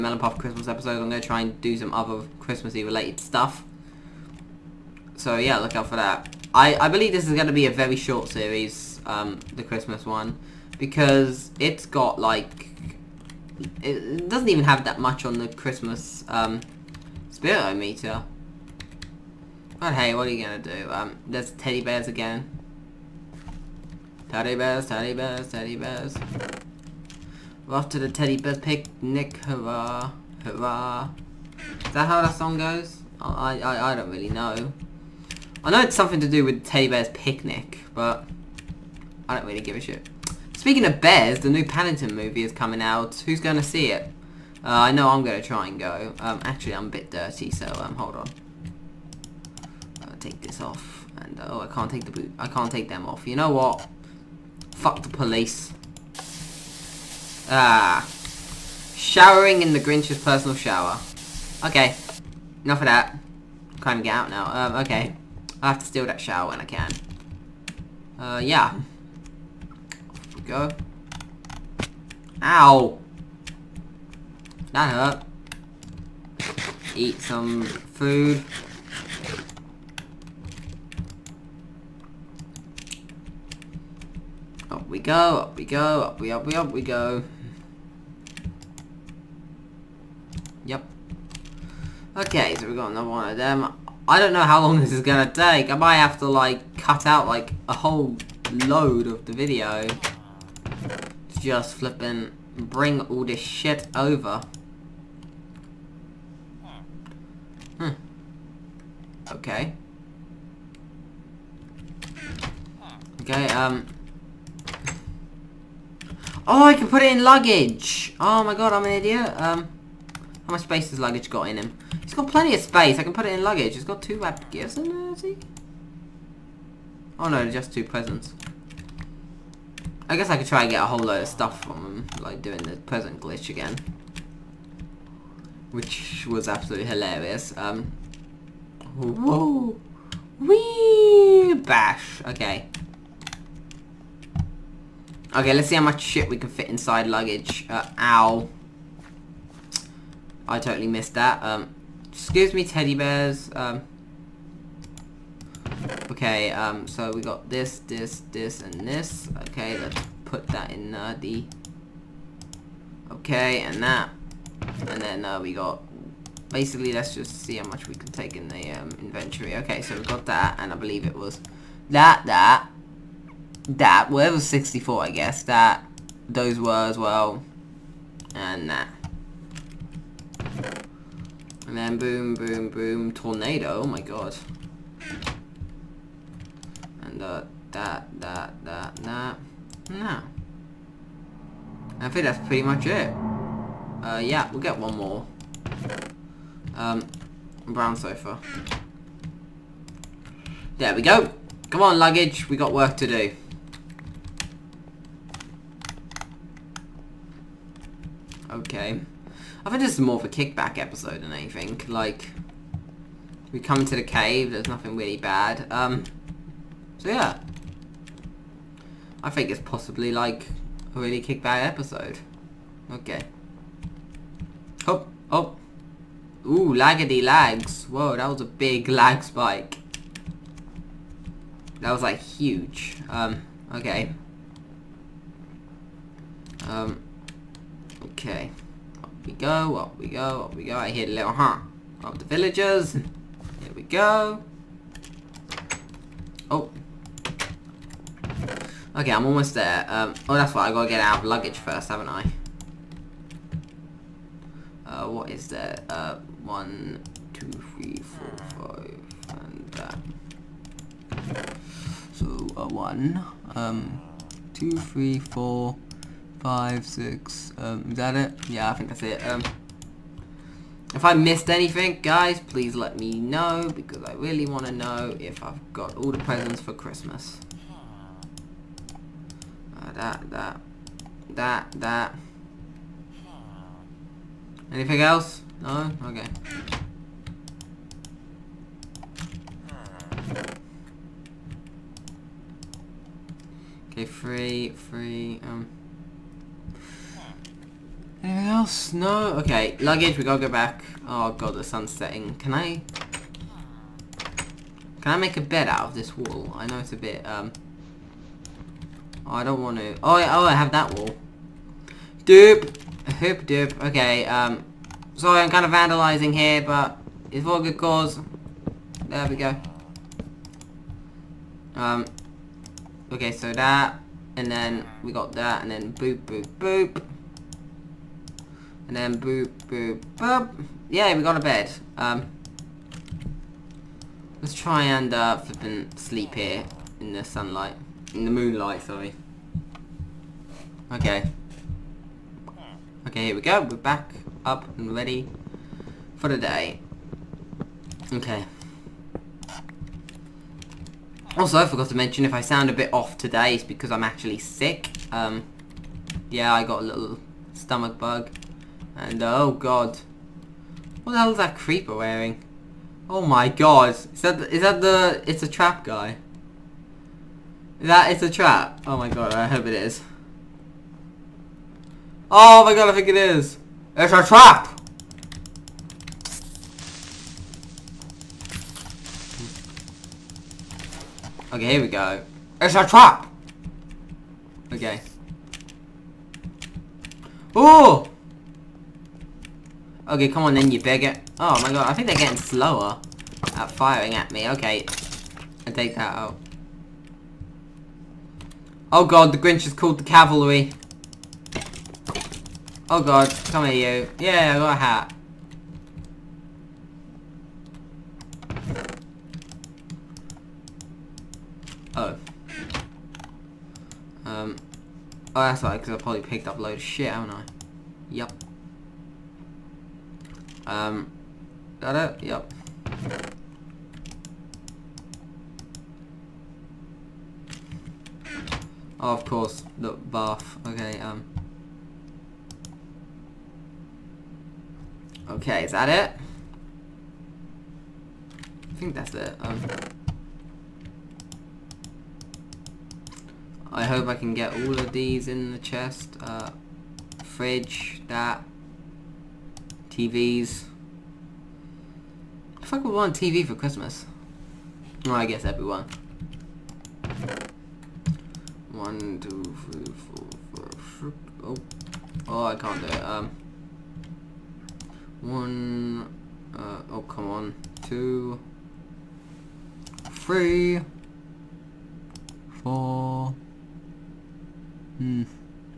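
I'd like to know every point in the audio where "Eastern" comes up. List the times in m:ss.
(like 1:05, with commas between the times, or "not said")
not said.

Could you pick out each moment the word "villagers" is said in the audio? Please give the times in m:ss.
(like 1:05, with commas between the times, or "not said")
4:02.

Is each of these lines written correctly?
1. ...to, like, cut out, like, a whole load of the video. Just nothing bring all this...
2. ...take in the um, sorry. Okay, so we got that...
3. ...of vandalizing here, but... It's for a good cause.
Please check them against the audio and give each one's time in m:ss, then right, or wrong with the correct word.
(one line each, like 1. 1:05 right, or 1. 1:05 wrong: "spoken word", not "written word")
1. 1:36 wrong: "flipping", not "nothing"
2. 2:48 wrong: "inventory", not "sorry"
3. 5:15 right.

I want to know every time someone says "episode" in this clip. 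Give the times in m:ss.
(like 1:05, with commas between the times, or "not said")
0:00, 3:30, 3:41.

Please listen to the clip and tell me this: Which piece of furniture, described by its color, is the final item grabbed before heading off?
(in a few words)
Brown sofa.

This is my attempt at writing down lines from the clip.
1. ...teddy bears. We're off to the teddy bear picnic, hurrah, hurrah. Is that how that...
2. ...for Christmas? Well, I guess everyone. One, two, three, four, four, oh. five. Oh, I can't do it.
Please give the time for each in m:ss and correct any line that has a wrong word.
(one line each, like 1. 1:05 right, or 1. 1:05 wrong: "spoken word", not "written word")
1. 0:25 right
2. 7:33 wrong: "four", not "five".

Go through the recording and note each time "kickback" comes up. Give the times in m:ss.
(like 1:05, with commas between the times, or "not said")
3:30, 3:41.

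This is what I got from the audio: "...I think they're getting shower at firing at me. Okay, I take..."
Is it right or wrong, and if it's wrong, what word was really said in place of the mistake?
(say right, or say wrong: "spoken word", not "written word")
wrong: "slower", not "shower".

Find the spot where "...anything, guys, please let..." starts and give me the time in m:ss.
4:31.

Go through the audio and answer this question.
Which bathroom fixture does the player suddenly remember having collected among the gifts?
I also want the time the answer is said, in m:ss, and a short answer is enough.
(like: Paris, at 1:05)
The bath, at 7:09.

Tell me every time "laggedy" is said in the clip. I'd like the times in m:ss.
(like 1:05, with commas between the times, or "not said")
3:46.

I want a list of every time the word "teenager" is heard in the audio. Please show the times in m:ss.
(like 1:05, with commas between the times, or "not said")
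not said.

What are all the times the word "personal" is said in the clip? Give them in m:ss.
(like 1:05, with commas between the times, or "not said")
1:00.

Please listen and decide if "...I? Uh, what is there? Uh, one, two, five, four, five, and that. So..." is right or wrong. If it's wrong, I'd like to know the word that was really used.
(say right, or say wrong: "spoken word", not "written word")
wrong: "three", not "five".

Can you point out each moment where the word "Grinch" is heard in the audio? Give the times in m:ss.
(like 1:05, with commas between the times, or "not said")
0:59, 6:39.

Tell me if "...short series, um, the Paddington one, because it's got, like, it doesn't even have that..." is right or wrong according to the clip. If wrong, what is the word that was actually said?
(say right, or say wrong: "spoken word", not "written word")
wrong: "Christmas", not "Paddington".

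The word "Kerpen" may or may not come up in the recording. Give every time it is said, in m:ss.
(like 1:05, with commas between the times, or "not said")
not said.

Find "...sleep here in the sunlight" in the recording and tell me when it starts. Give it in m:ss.
5:35.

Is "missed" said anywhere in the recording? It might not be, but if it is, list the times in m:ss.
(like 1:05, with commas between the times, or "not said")
2:30, 4:31.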